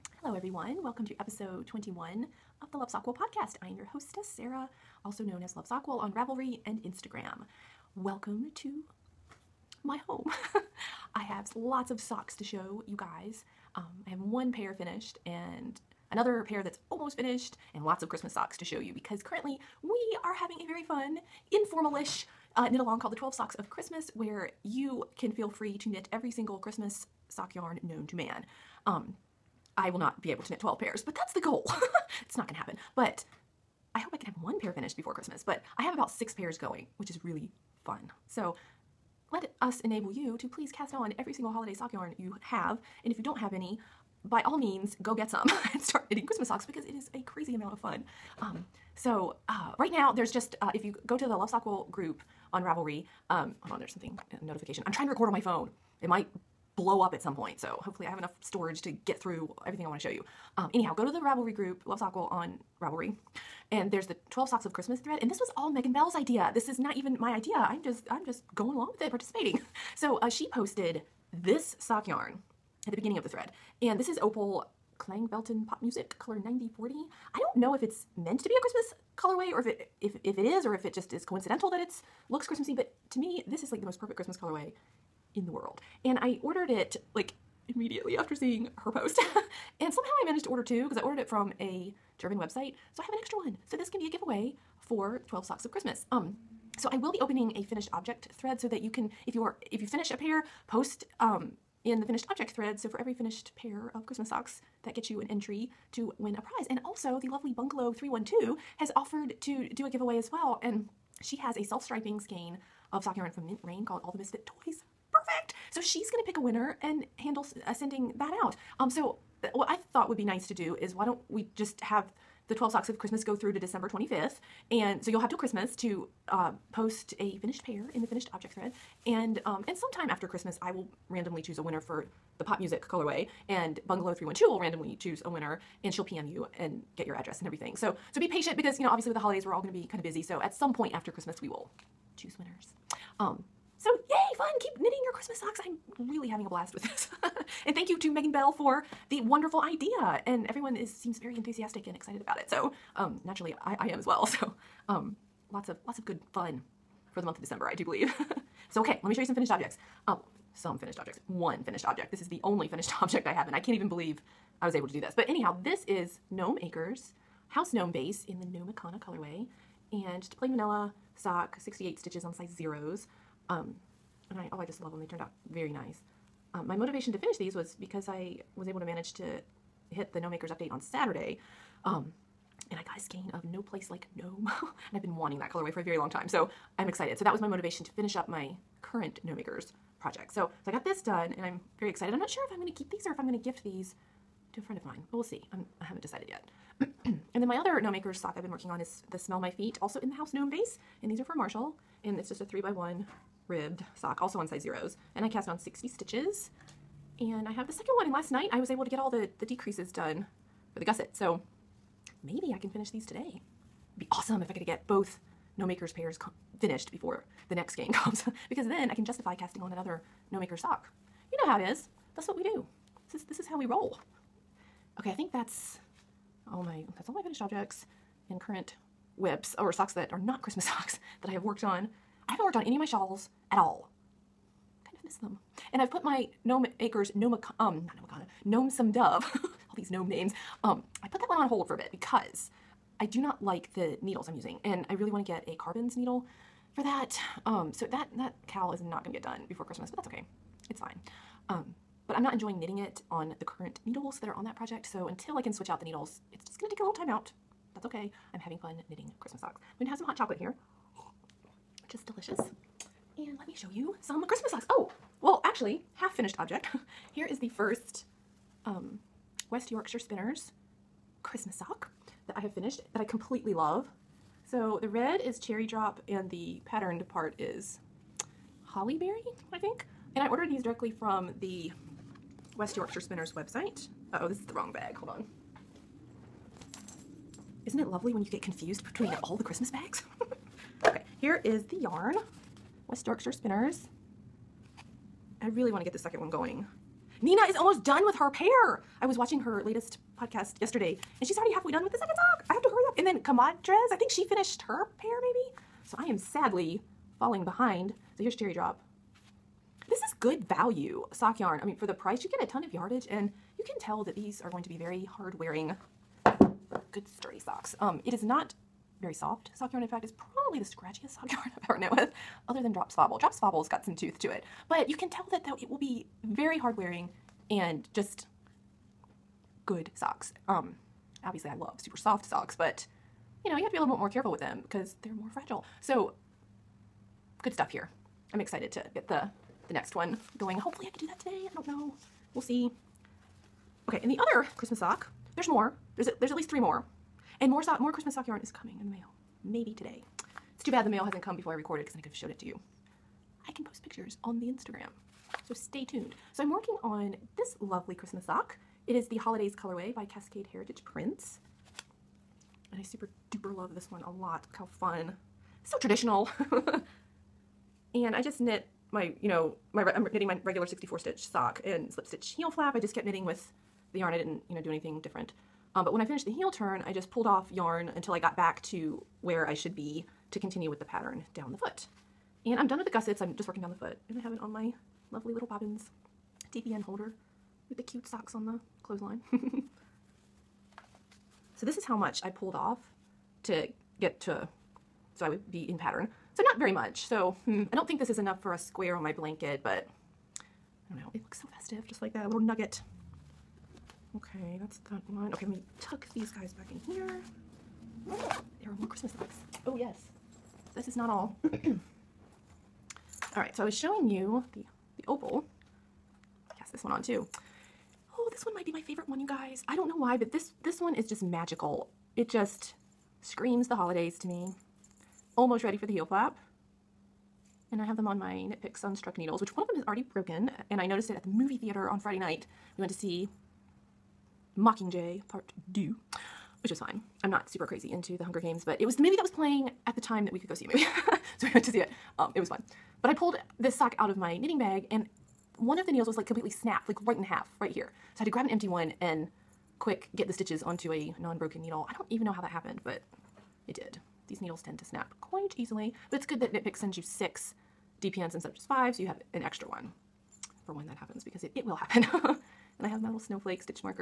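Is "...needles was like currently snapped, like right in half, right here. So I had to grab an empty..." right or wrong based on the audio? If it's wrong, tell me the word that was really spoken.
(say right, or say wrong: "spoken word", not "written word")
wrong: "completely", not "currently".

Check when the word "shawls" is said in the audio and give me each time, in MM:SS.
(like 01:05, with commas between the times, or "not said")
03:52.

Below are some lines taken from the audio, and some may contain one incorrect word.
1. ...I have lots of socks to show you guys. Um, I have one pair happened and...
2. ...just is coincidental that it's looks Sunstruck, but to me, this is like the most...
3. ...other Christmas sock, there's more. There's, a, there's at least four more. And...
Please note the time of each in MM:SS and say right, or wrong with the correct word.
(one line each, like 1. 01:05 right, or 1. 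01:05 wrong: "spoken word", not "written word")
1. 00:11 wrong: "finished", not "happened"
2. 01:20 wrong: "Christmassy", not "Sunstruck"
3. 05:44 wrong: "three", not "four".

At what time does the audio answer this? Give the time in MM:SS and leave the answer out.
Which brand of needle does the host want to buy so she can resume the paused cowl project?
04:05.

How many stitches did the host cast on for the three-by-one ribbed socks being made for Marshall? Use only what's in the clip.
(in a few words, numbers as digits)
60.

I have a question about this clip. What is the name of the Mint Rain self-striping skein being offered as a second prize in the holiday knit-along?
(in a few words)
All the Misfit Toys.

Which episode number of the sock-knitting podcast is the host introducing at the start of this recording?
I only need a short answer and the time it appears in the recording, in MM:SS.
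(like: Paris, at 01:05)
21, at 00:01.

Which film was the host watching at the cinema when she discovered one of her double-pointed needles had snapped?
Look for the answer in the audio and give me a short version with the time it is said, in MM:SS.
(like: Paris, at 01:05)
Mockingjay Part 2, at 07:14.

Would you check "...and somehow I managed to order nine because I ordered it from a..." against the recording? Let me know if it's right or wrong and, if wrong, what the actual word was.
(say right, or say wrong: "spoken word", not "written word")
wrong: "two", not "nine".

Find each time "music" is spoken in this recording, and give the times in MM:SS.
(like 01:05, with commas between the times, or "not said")
01:15, 02:12.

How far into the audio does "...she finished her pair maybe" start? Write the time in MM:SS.
05:04.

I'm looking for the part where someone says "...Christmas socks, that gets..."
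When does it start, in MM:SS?
01:44.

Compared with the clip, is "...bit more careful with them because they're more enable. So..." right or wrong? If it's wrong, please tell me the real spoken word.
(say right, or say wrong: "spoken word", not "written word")
wrong: "fragile", not "enable".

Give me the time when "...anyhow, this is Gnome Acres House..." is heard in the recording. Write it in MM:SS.
02:45.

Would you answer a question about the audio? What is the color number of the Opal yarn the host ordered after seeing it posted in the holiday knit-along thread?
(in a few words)
9040.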